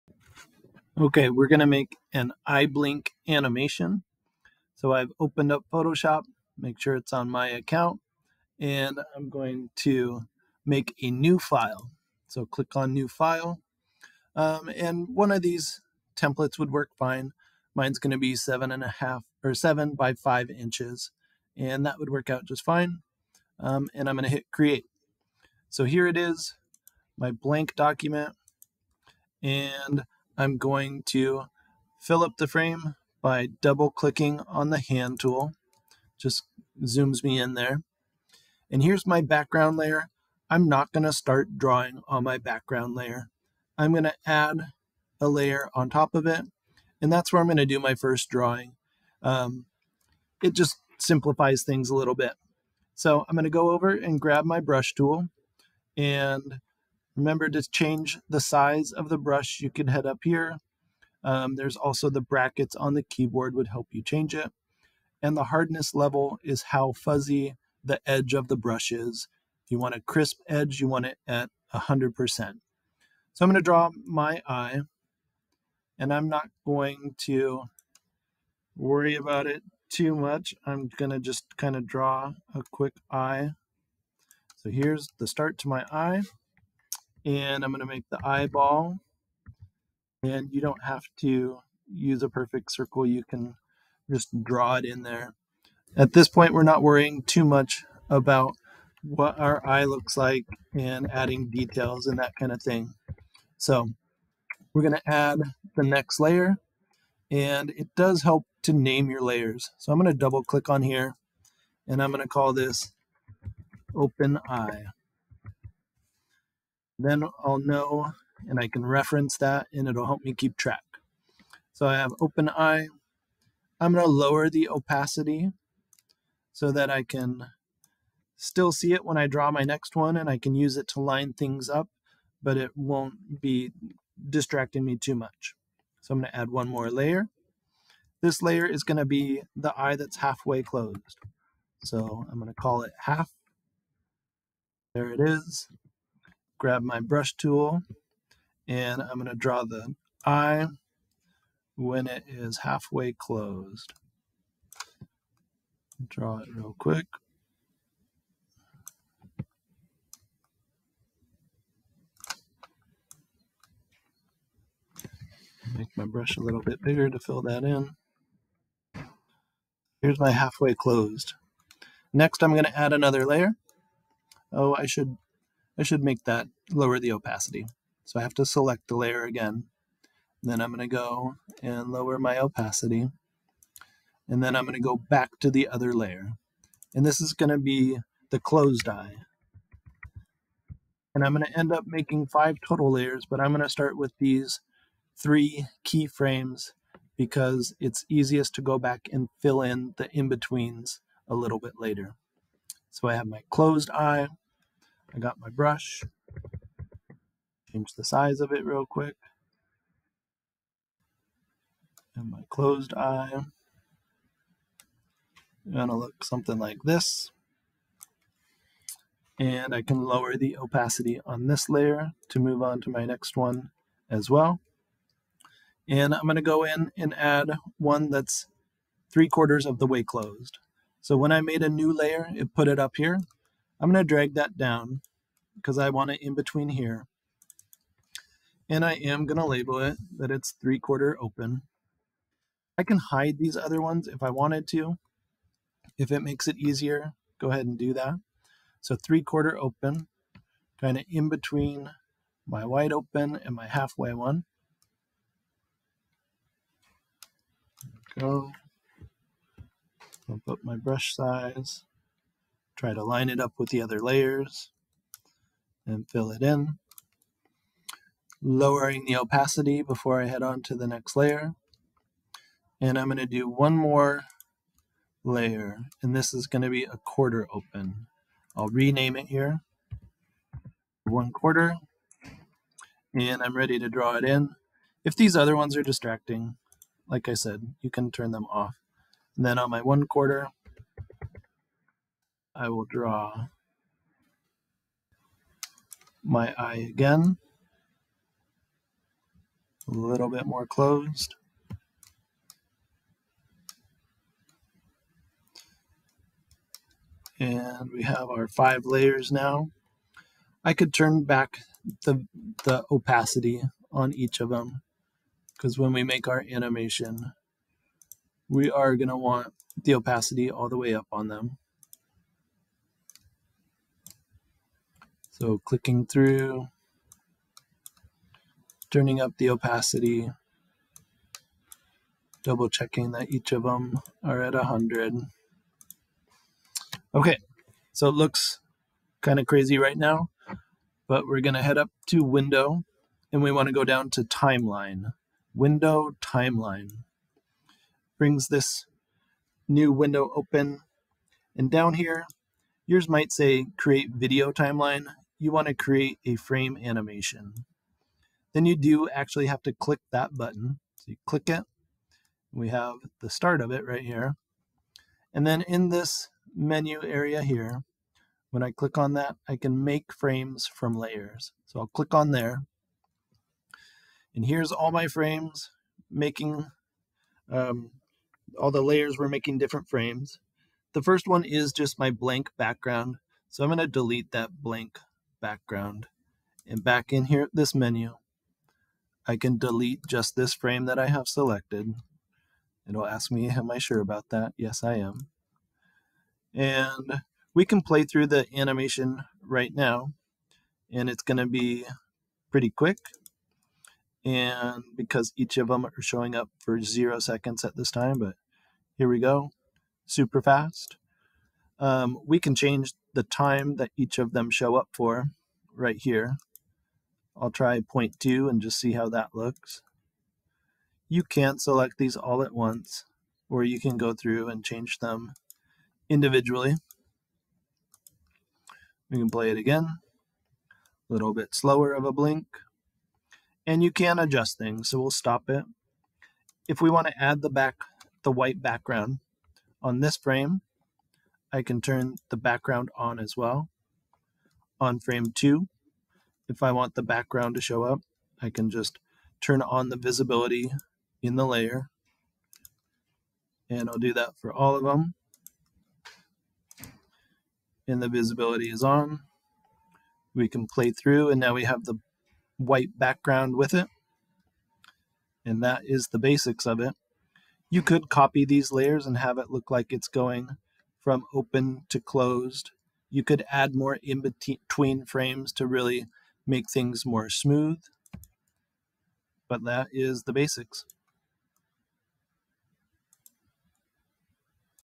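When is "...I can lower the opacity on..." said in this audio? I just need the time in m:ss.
3:39.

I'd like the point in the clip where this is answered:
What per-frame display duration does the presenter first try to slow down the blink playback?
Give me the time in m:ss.
6:57.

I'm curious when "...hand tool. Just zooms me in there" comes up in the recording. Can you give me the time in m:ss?
0:34.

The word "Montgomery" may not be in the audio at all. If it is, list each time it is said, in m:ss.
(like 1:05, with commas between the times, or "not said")
not said.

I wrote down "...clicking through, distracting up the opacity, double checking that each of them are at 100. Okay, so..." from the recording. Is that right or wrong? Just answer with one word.
wrong.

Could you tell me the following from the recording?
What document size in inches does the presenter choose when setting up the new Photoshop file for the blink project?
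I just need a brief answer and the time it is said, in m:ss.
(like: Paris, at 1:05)
7 by 5 inches, at 0:19.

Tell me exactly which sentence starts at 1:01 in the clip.
Um, there's also the brackets on the keyboard would help you change it.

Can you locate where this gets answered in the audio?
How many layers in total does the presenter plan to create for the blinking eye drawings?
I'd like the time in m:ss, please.
3:12.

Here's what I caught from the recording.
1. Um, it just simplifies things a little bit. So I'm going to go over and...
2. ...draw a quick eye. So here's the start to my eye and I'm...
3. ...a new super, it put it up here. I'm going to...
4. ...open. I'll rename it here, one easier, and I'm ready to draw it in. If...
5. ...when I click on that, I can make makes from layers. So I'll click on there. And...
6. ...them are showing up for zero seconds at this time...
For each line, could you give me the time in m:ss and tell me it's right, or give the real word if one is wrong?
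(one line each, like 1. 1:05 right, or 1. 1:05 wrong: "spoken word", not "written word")
1. 0:49 right
2. 1:21 right
3. 3:51 wrong: "layer", not "super"
4. 4:37 wrong: "quarter", not "easier"
5. 6:08 wrong: "frames", not "makes"
6. 6:45 right.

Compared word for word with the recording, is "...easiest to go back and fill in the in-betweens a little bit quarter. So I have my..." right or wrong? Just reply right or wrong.
wrong.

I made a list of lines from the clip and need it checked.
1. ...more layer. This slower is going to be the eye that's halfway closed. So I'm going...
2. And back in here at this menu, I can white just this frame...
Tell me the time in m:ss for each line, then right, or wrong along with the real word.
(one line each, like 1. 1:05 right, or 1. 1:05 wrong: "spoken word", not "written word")
1. 2:16 wrong: "layer", not "slower"
2. 6:26 wrong: "delete", not "white".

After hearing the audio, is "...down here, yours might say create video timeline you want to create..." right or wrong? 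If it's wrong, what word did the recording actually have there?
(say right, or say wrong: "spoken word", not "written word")
right.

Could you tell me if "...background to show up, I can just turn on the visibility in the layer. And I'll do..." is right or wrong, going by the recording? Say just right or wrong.
right.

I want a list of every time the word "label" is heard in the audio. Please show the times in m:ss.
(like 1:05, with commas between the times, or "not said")
3:59.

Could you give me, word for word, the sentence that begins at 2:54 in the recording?
Oh, I should I should make that lower the opacity.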